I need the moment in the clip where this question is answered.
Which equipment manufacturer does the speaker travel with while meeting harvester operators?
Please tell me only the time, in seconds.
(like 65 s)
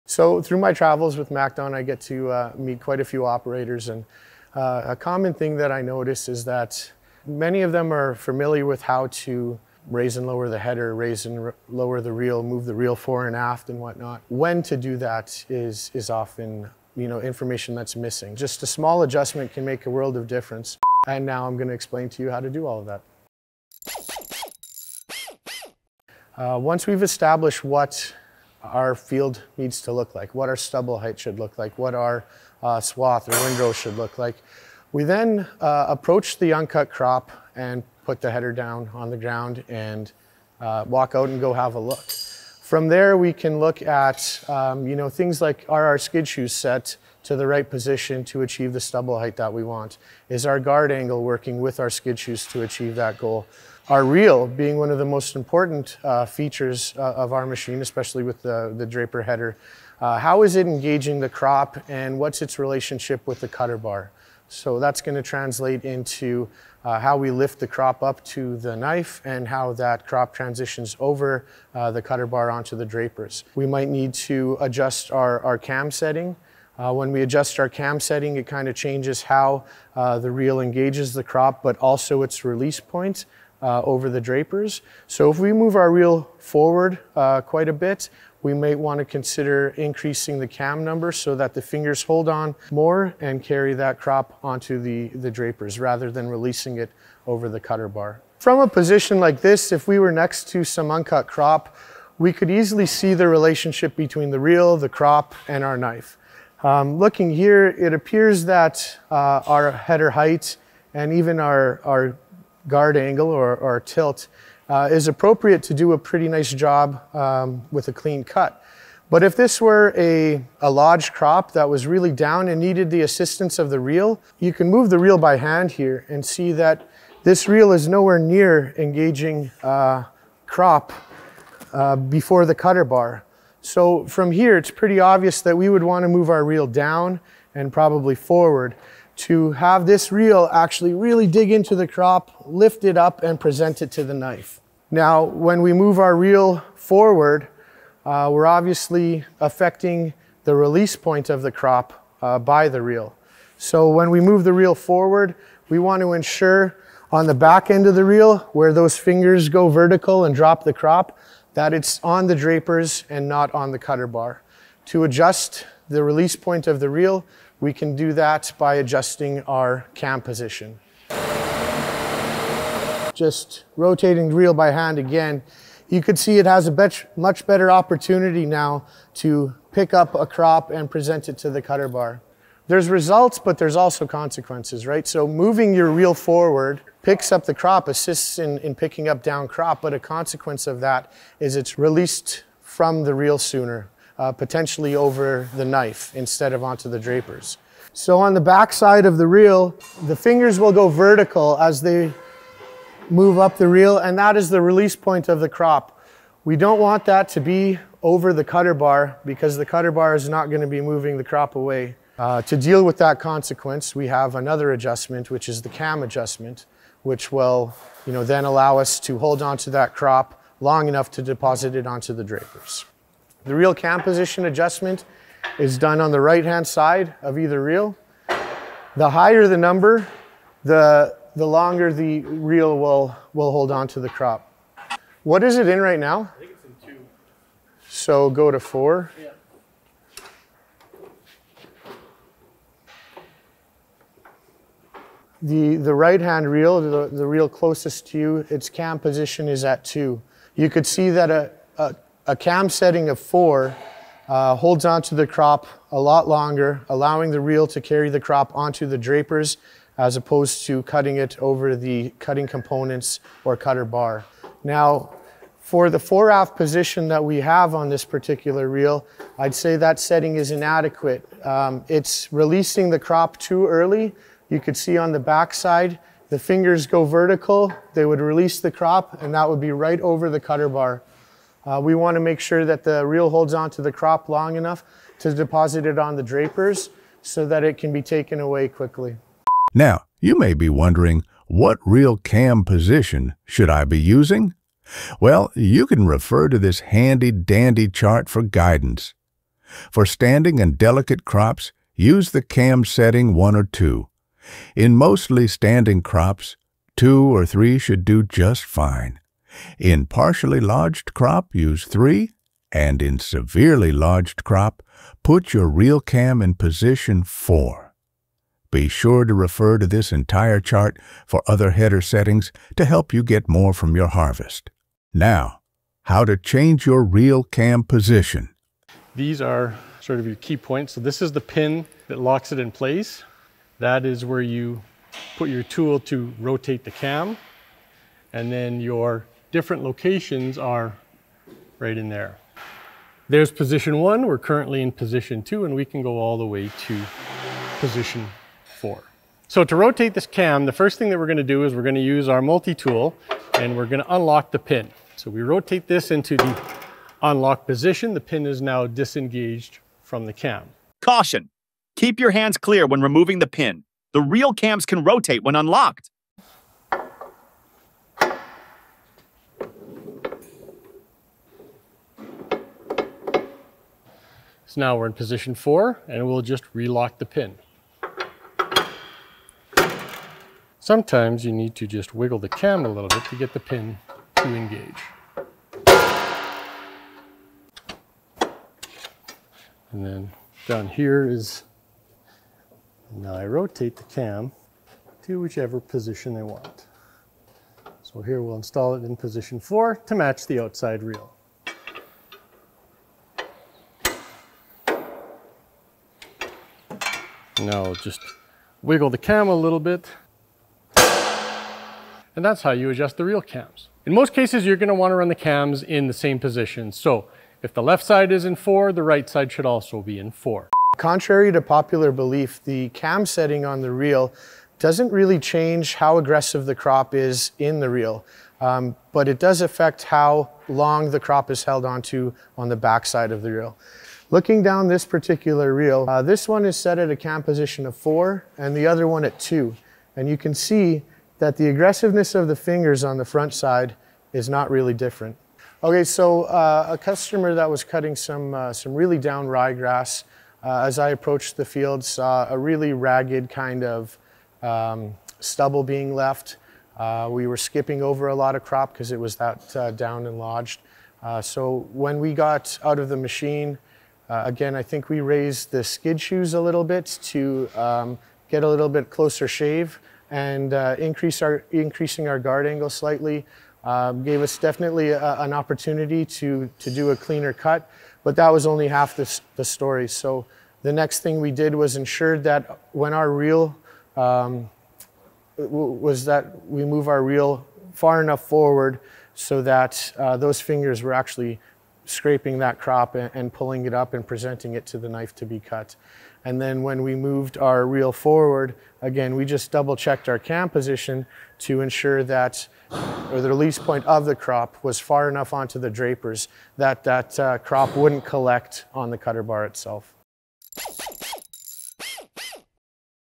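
1 s.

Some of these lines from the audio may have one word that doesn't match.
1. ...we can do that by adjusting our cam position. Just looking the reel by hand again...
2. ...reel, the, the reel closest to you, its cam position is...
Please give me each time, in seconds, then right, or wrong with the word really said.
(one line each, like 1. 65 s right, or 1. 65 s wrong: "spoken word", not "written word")
1. 167 s wrong: "rotating", not "looking"
2. 246 s right.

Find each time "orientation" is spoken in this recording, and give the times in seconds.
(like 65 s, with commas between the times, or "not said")
not said.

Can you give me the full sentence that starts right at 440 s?
And you can see that the aggressiveness of the fingers on the front side is not really different.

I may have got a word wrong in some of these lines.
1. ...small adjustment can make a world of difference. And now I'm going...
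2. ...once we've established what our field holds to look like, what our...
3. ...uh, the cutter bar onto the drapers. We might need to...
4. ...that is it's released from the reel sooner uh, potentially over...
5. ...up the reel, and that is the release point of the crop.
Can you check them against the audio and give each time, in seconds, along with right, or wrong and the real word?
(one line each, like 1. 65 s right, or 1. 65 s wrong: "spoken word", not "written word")
1. 18 s right
2. 26 s wrong: "needs", not "holds"
3. 71 s right
4. 190 s right
5. 203 s right.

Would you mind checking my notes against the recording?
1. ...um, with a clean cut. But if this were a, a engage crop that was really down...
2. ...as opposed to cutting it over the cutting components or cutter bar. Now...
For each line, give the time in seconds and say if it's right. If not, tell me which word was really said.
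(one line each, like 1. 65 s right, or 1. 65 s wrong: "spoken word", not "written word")
1. 117 s wrong: "lodge", not "engage"
2. 259 s right.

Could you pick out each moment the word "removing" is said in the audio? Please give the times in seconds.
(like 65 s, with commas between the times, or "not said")
363 s.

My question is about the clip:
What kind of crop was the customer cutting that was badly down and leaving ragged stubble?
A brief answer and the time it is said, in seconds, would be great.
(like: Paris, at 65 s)
ryegrass, at 449 s.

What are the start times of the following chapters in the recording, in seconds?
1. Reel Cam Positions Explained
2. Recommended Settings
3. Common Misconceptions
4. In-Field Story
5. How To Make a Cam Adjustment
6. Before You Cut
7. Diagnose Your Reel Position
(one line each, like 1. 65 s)
1. 197 s
2. 290 s
3. 421 s
4. 445 s
5. 329 s
6. 26 s
7. 98 s.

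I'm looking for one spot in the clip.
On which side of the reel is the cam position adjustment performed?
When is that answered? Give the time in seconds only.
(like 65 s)
226 s.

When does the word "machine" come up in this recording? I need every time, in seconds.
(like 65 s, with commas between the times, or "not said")
57 s, 463 s.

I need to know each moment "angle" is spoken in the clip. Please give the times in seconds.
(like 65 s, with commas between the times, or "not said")
50 s, 112 s, 472 s.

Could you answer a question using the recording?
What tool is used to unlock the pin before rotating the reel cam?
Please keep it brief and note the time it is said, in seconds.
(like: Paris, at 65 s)
multi-tool, at 352 s.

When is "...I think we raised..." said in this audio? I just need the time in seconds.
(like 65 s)
464 s.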